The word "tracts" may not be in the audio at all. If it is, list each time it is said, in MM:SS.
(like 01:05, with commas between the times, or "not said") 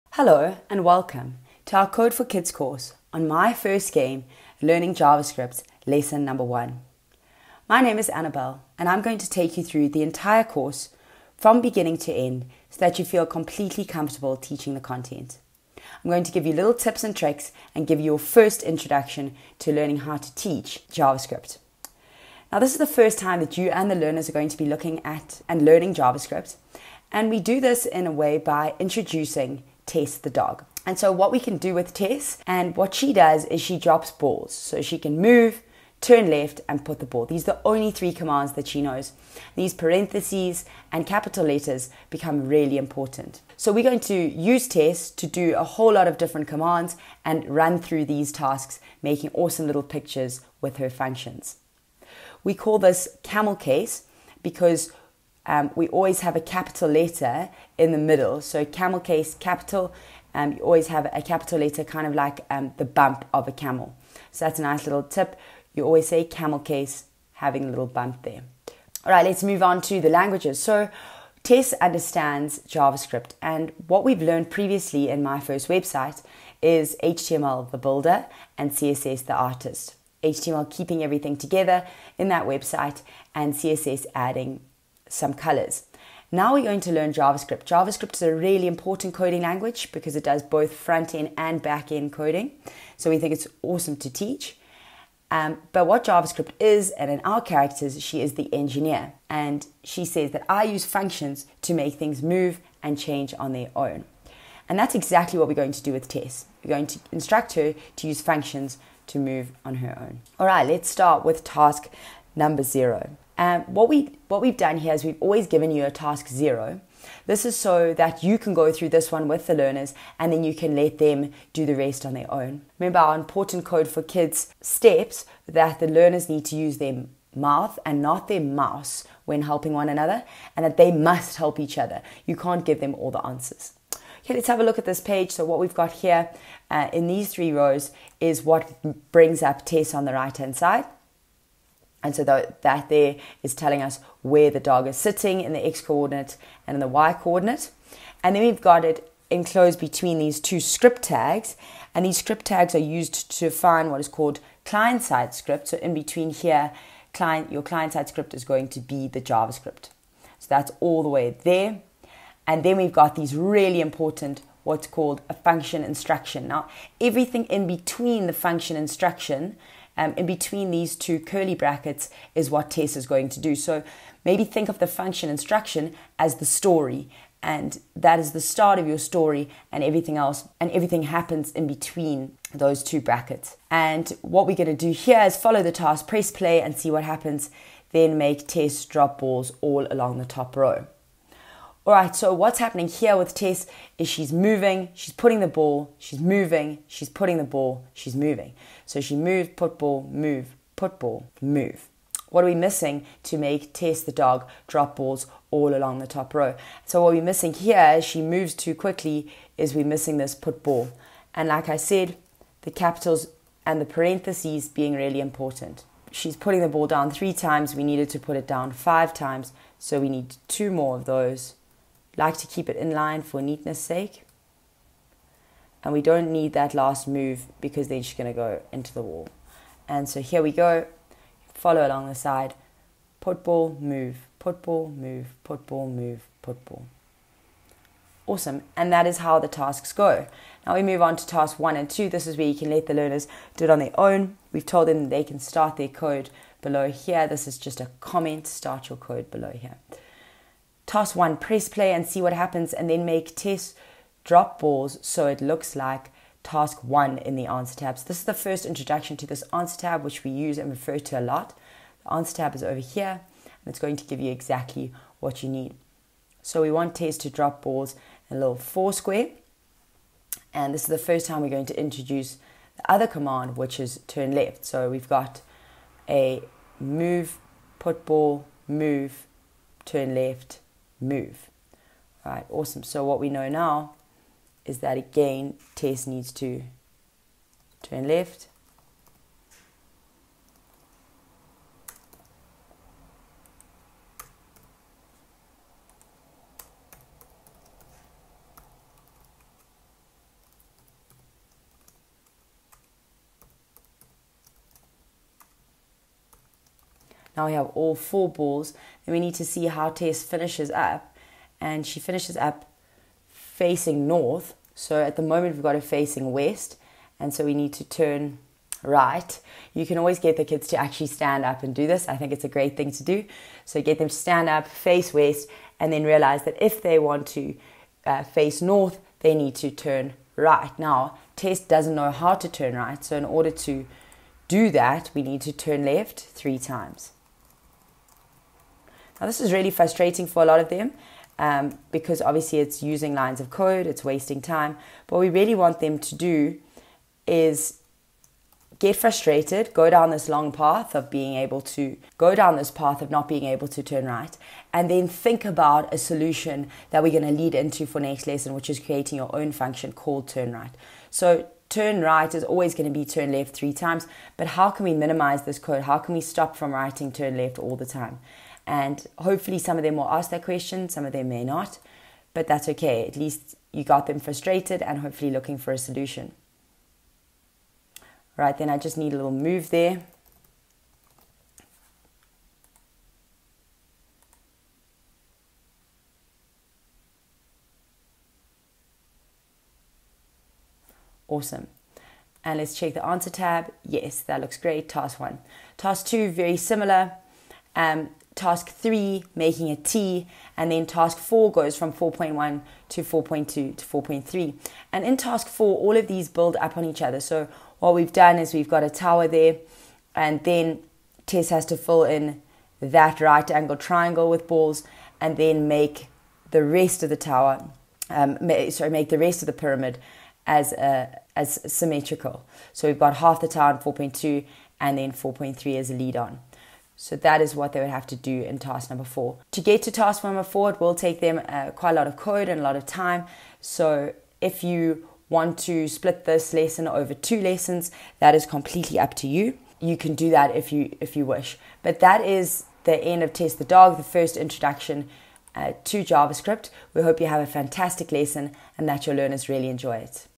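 not said.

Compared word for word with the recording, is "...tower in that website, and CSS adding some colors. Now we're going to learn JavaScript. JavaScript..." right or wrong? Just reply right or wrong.
wrong.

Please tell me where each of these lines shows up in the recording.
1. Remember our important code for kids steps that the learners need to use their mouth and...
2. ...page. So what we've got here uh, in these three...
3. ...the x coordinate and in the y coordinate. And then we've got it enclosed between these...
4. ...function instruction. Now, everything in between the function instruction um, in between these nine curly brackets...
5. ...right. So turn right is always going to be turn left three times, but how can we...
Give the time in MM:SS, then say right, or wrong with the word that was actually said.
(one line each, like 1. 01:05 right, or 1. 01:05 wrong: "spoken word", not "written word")
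1. 02:02 right
2. 02:15 right
3. 02:25 right
4. 02:45 wrong: "two", not "nine"
5. 06:00 right.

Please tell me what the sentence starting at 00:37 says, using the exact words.
These are the only three commands that she knows.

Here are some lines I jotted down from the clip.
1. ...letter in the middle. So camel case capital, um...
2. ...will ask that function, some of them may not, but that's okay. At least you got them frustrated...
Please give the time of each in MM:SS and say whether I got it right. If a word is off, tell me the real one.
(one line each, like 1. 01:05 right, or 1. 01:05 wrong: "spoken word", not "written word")
1. 00:56 right
2. 06:09 wrong: "question", not "function".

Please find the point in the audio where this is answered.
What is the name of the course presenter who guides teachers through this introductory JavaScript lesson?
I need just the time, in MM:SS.
00:08.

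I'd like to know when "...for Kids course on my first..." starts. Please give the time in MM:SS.
00:02.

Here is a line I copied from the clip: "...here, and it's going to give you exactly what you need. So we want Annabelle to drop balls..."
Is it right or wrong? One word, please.
wrong.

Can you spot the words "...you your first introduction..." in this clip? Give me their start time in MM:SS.
00:17.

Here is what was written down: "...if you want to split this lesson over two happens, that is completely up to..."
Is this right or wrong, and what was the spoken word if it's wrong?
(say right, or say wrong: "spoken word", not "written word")
wrong: "lessons", not "happens".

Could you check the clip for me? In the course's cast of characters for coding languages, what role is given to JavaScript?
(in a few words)
engineer.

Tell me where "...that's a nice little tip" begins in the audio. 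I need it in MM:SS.
01:04.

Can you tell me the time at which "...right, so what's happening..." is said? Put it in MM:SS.
03:11.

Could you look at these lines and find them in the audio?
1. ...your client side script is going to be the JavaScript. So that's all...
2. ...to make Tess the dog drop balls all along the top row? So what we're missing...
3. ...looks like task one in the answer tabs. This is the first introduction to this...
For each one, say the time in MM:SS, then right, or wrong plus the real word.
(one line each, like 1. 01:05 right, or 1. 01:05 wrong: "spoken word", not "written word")
1. 02:37 right
2. 03:23 right
3. 04:15 right.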